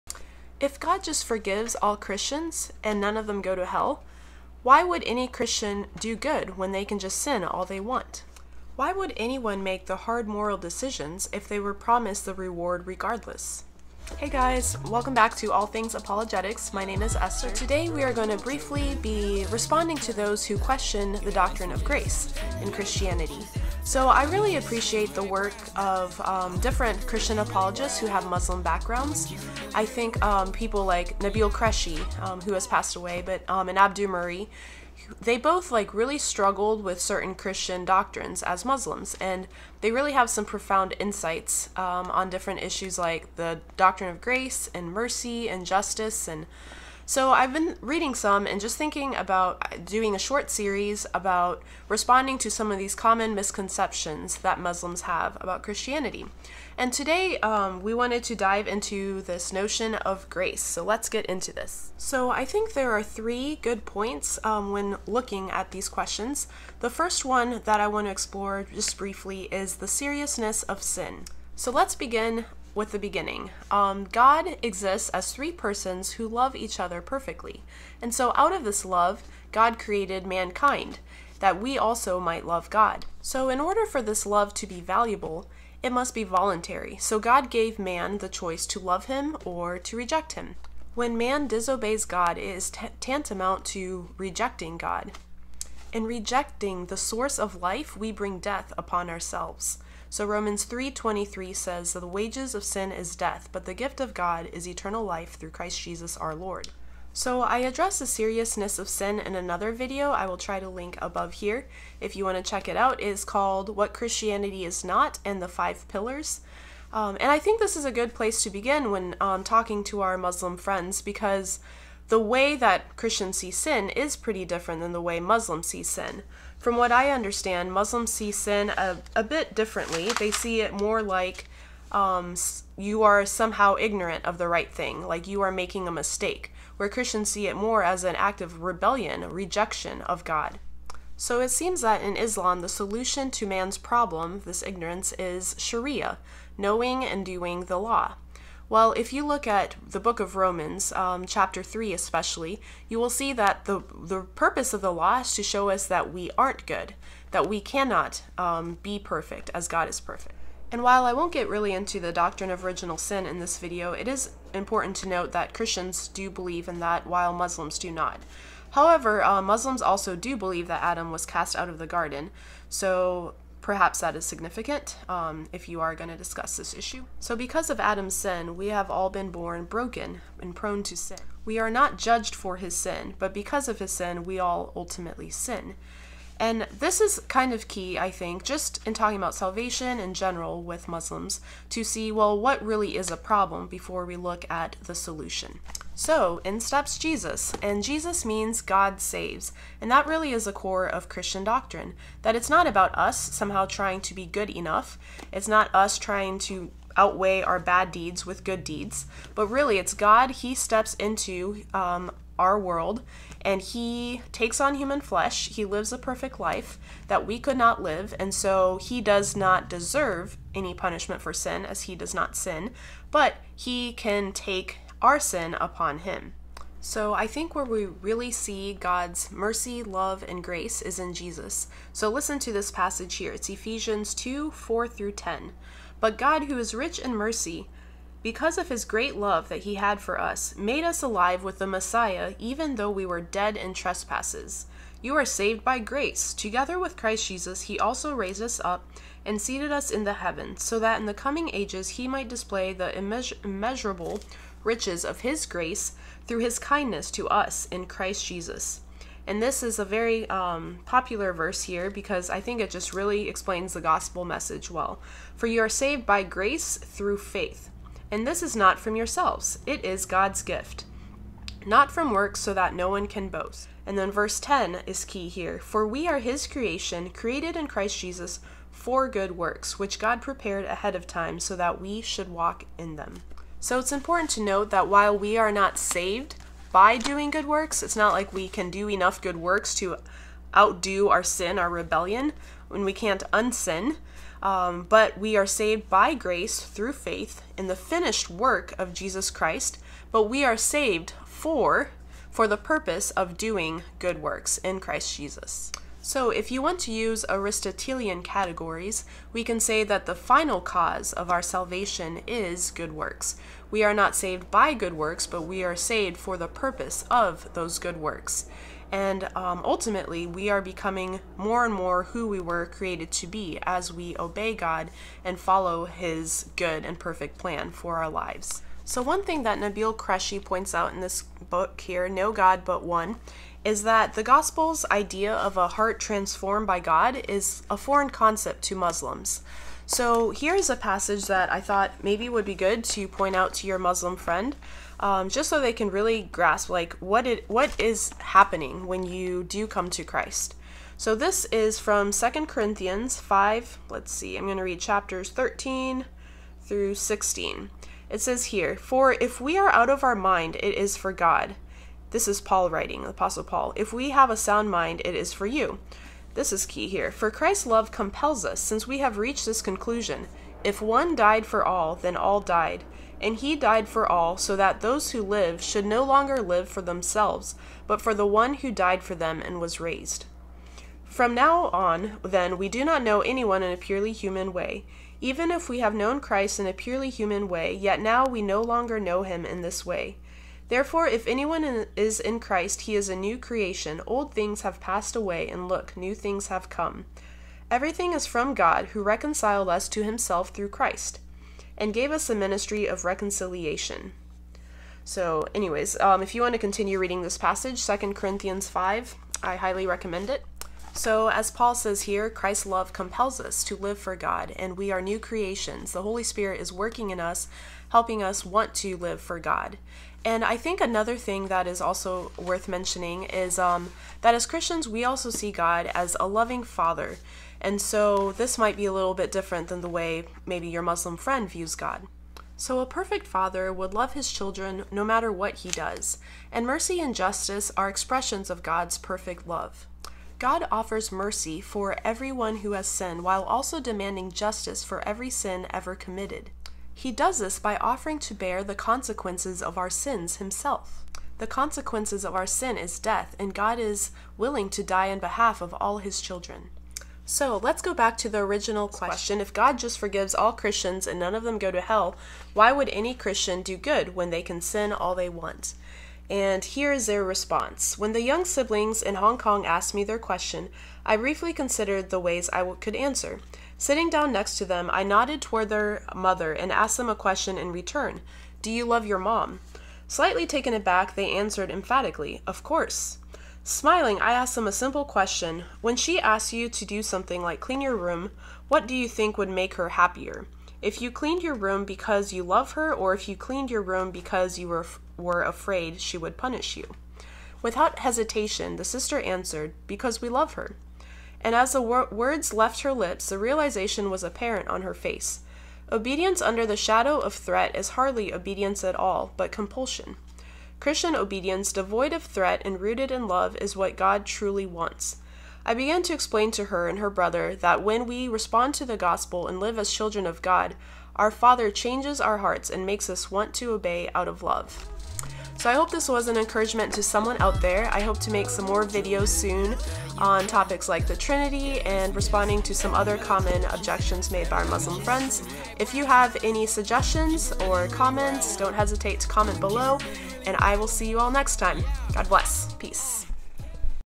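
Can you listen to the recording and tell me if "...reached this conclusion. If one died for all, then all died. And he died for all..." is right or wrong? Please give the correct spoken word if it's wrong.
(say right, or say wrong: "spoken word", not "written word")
right.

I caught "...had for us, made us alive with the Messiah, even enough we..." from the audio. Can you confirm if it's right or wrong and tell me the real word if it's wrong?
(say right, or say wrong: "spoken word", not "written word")
wrong: "though", not "enough".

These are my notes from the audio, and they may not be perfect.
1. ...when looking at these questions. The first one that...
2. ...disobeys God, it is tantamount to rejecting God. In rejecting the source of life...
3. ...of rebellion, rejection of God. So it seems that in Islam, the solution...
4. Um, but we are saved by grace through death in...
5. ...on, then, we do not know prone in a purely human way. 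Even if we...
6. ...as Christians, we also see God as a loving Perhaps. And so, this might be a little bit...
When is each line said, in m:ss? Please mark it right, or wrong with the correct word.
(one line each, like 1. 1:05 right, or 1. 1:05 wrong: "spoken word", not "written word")
1. 1:04 right
2. 1:31 right
3. 2:18 right
4. 4:54 wrong: "faith", not "death"
5. 6:21 wrong: "anyone", not "prone"
6. 7:04 wrong: "Father", not "Perhaps".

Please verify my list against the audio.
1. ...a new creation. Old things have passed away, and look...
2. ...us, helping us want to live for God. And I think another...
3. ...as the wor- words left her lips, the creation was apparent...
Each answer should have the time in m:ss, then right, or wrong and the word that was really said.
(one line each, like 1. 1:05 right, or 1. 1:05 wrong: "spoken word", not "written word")
1. 6:33 right
2. 6:57 right
3. 8:21 wrong: "realization", not "creation".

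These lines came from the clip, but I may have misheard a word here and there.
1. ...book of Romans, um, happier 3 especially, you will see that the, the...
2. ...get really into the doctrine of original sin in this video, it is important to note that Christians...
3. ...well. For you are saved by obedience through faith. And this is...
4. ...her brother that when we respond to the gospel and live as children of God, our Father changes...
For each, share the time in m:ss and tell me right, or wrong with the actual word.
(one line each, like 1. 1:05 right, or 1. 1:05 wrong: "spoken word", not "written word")
1. 2:29 wrong: "chapter", not "happier"
2. 2:41 right
3. 4:24 wrong: "grace", not "obedience"
4. 8:36 right.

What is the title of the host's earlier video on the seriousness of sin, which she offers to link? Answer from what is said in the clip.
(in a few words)
What Christianity Is Not and the Five Pillars.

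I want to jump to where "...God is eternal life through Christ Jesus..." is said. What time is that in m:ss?
1:44.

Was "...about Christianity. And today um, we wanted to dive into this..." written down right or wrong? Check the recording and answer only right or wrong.
right.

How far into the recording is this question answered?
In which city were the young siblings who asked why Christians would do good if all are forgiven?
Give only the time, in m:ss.
7:49.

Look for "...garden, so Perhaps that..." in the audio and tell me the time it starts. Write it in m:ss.
2:51.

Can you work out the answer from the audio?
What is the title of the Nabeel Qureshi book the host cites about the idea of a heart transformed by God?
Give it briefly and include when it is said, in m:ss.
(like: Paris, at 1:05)
No God But One, at 5:32.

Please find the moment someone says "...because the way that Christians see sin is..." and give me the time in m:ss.
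2:01.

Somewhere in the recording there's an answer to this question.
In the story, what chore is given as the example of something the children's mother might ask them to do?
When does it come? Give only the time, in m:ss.
8:07.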